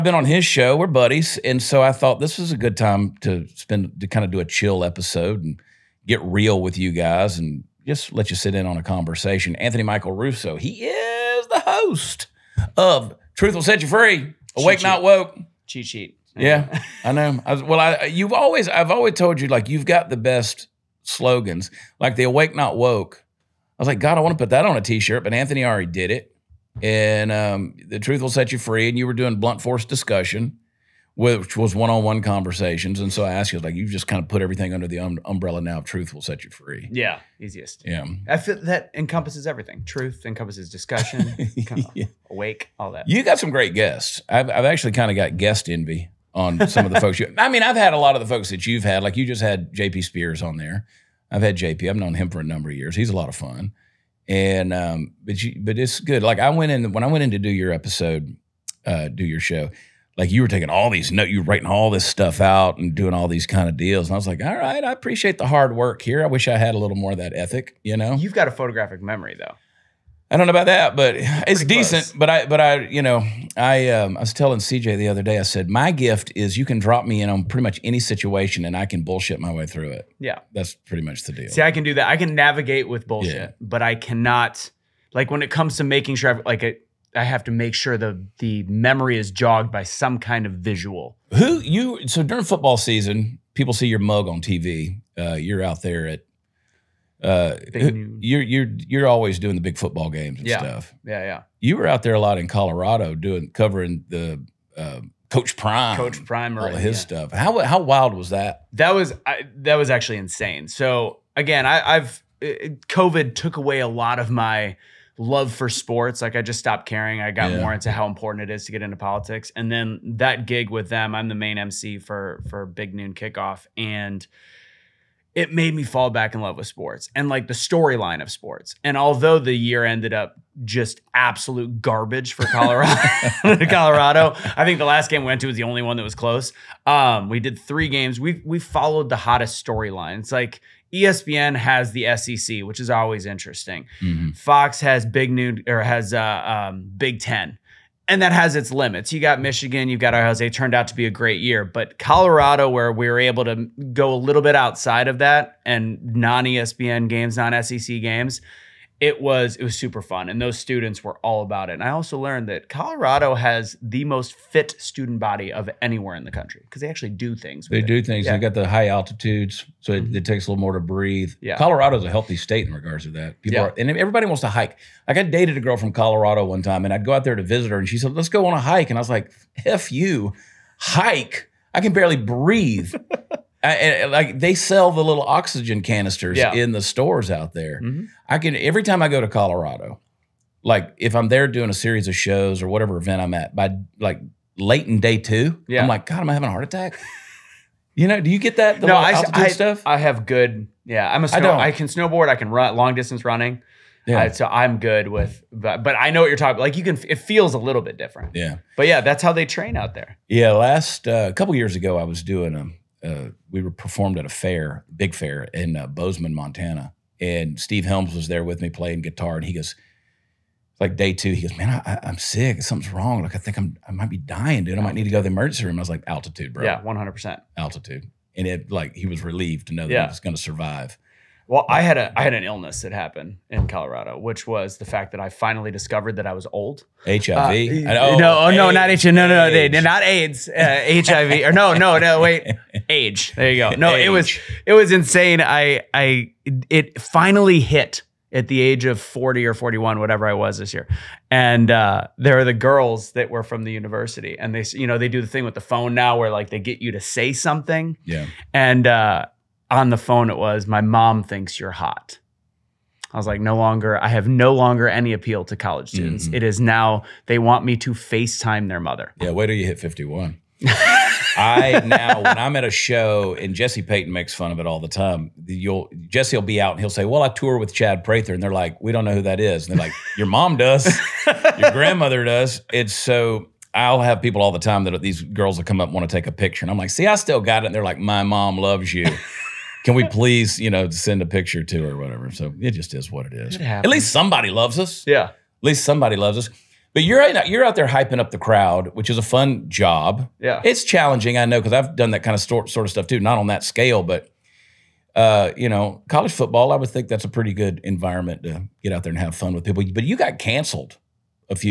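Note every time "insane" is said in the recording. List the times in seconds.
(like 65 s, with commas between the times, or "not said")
110 s, 244 s.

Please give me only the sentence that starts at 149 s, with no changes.
You got Michigan, you've got Ohio State.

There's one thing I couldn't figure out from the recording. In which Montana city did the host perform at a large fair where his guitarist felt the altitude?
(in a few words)
Bozeman.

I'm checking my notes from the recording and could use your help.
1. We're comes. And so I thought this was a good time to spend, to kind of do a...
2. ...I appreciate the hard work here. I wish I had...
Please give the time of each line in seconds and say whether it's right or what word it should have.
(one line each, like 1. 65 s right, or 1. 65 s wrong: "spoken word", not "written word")
1. 0 s wrong: "buddies", not "comes"
2. 64 s right.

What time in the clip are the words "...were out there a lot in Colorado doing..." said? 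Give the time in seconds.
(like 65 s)
101 s.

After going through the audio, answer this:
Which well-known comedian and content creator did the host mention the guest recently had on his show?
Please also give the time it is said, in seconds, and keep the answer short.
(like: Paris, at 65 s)
J.P. Sears, at 49 s.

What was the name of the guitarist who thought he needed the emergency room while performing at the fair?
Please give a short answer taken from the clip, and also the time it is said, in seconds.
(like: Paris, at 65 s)
Steve Helms, at 217 s.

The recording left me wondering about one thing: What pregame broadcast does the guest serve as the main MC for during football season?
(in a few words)
Big Noon Kickoff.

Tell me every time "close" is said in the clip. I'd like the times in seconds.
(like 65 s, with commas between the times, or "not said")
72 s, 136 s.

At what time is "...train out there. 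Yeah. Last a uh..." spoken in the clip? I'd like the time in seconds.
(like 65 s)
209 s.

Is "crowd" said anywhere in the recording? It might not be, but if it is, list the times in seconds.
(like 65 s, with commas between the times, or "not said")
298 s.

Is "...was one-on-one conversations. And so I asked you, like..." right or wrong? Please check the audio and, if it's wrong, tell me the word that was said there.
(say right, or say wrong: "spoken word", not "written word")
right.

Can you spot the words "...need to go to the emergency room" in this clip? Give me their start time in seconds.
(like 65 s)
224 s.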